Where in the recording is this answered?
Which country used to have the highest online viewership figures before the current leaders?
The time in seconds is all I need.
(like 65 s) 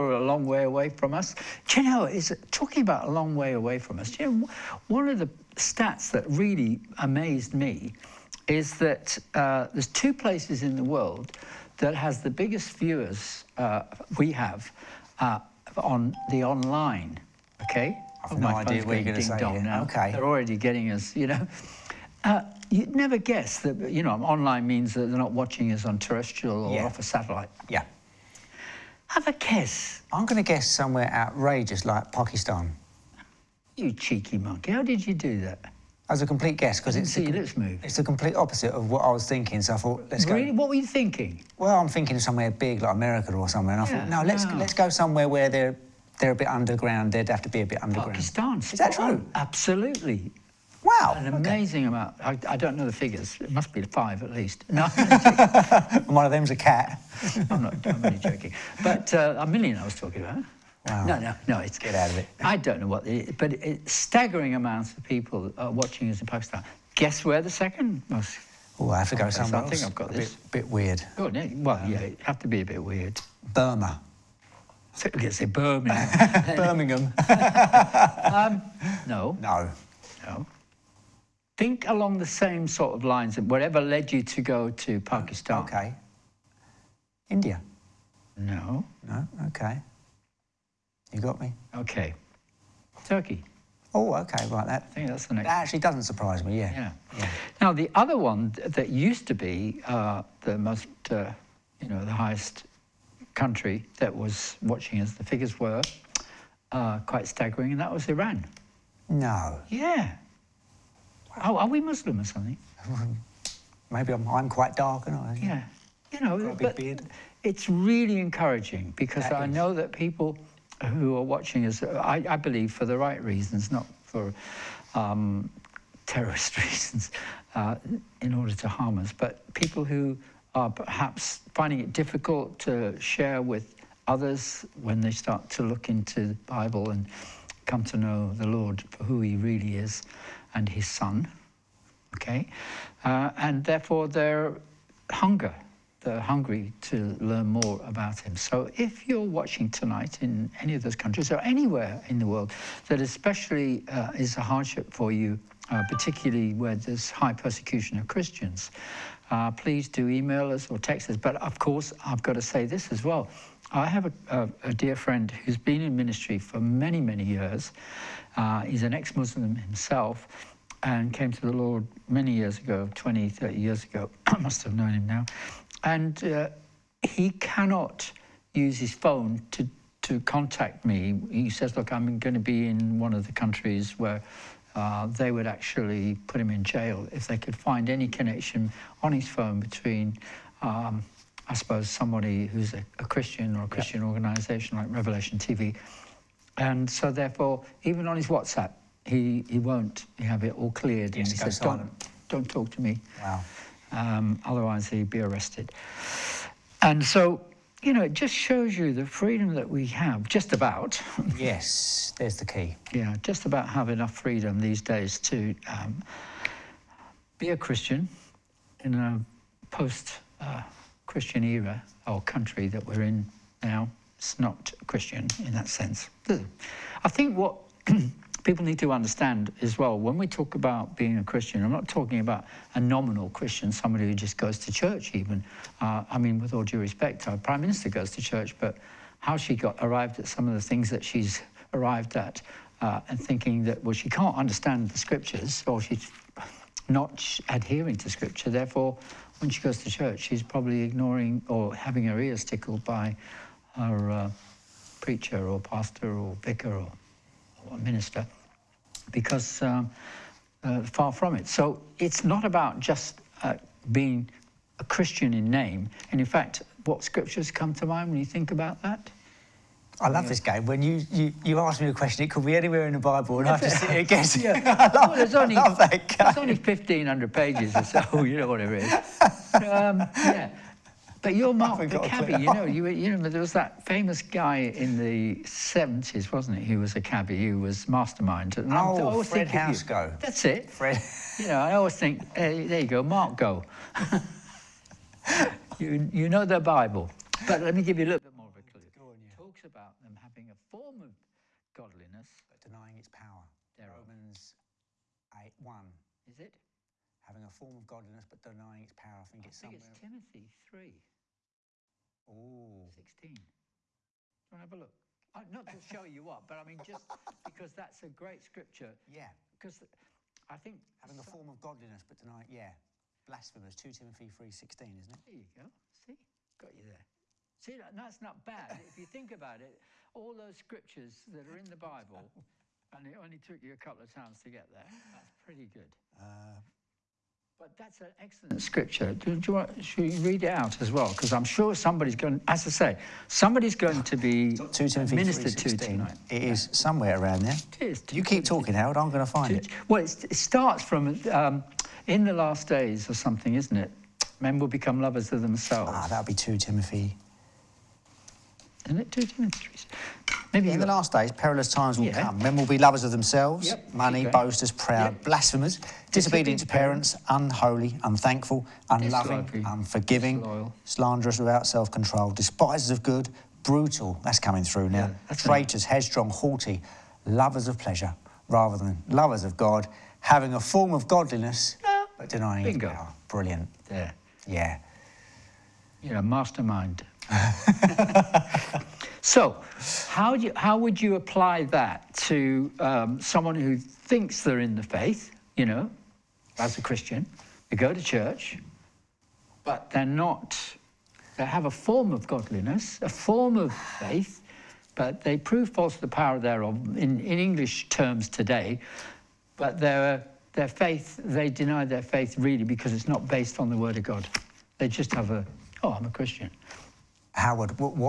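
108 s.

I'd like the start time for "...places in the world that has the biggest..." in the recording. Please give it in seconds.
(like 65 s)
10 s.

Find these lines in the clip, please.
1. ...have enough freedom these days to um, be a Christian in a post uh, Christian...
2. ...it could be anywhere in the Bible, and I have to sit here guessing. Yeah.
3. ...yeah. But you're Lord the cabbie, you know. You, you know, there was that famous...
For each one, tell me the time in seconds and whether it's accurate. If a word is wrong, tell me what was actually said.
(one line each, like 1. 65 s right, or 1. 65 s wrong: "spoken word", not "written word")
1. 213 s right
2. 272 s right
3. 280 s wrong: "Mark", not "Lord".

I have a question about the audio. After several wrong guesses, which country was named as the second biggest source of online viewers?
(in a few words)
Turkey.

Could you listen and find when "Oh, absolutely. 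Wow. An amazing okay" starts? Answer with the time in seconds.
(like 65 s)
49 s.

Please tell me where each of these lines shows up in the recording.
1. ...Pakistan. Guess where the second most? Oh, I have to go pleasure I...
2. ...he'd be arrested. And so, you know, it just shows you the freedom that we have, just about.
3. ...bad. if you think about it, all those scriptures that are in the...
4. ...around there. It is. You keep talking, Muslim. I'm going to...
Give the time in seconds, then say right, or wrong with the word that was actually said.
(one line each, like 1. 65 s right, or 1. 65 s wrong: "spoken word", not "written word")
1. 66 s wrong: "somewhere", not "pleasure"
2. 204 s right
3. 328 s right
4. 347 s wrong: "Howard", not "Muslim".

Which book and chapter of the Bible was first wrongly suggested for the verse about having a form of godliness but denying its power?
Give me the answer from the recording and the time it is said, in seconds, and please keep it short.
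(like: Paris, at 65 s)
Romans 8, at 303 s.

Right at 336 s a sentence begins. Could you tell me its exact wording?
Uh, but that's an excellent scripture.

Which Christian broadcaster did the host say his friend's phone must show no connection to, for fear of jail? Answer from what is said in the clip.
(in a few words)
Revelation TV.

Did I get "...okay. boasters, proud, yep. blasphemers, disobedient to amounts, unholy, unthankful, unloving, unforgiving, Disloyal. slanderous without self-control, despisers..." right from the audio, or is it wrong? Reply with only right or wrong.
wrong.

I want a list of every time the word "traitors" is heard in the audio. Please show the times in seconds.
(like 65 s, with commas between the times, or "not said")
375 s.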